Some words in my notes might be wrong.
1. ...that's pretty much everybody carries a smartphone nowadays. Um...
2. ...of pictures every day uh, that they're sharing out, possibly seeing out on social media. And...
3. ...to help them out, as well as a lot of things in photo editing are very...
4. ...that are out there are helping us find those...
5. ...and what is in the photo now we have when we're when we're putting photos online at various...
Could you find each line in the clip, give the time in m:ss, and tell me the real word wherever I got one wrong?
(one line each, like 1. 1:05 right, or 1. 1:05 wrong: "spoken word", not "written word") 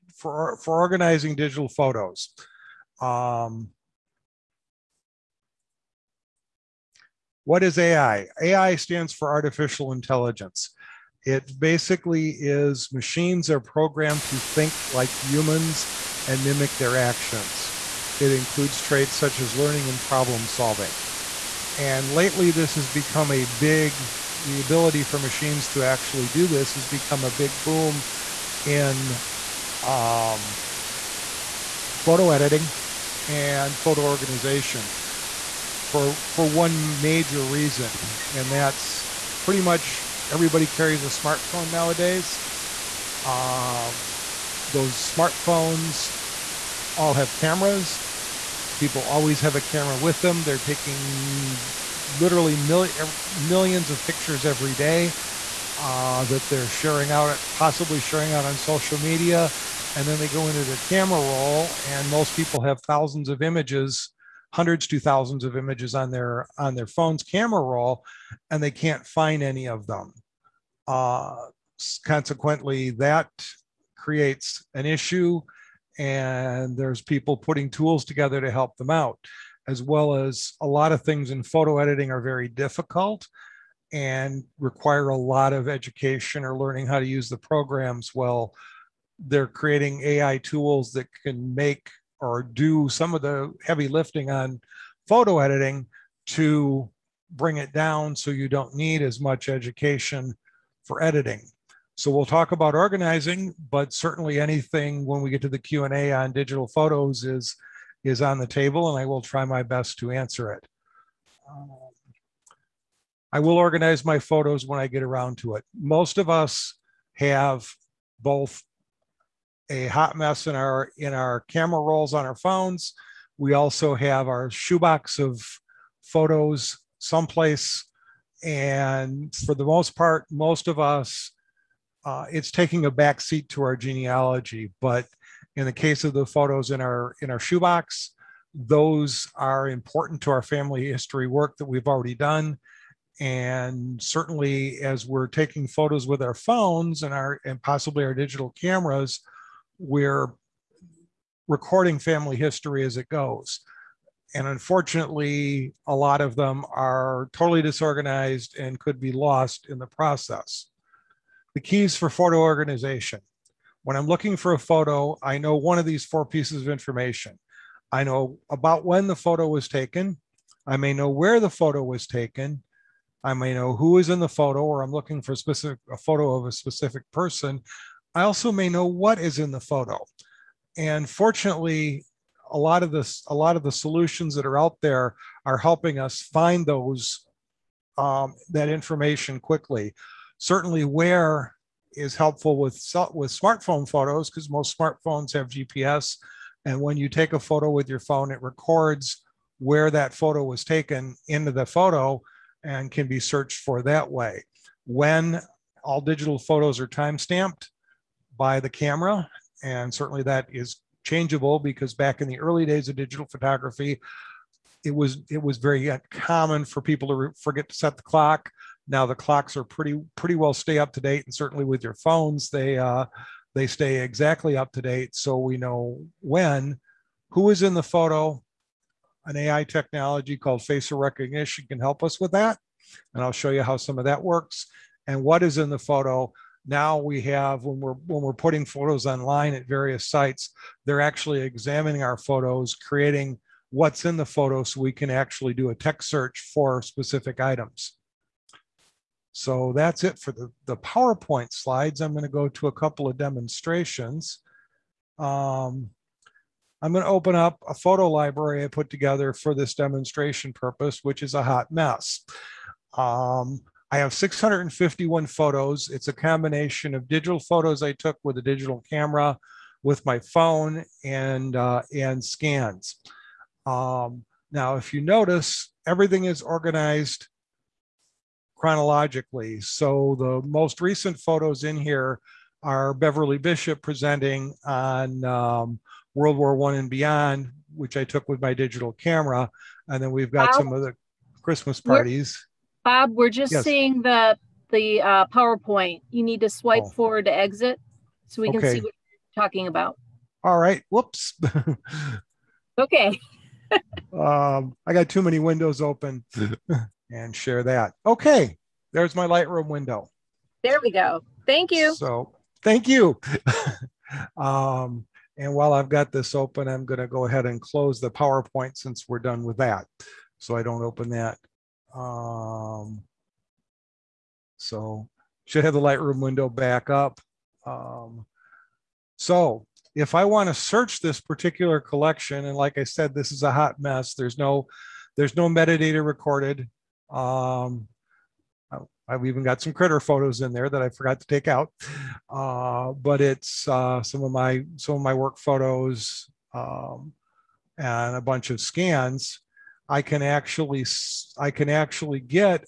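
1. 0:38 right
2. 0:53 wrong: "sharing", not "seeing"
3. 1:18 right
4. 3:04 right
5. 3:55 right.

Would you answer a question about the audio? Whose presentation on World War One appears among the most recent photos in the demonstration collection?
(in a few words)
Beverly Bishop.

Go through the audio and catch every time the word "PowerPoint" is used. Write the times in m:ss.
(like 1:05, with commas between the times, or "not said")
4:10, 4:55, 5:18.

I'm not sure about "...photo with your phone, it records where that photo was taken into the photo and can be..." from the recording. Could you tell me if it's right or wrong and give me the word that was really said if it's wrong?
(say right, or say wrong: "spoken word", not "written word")
right.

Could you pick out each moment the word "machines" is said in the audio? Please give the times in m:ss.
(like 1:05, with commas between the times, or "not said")
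0:12, 0:25.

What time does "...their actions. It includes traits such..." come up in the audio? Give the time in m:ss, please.
0:16.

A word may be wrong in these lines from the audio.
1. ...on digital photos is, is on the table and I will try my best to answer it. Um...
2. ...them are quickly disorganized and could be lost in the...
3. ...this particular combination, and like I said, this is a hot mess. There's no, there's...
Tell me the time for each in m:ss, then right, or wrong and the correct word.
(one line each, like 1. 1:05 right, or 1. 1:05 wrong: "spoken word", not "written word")
1. 1:46 right
2. 2:36 wrong: "totally", not "quickly"
3. 5:31 wrong: "collection", not "combination".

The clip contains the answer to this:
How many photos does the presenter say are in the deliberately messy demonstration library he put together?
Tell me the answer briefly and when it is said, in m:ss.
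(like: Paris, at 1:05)
651, at 4:24.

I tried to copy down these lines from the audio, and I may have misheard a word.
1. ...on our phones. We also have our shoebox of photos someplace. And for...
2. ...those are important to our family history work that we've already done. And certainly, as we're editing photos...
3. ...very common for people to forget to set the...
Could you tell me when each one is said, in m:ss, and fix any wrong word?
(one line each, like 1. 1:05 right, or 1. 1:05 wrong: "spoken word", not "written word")
1. 2:02 right
2. 2:18 wrong: "taking", not "editing"
3. 3:35 right.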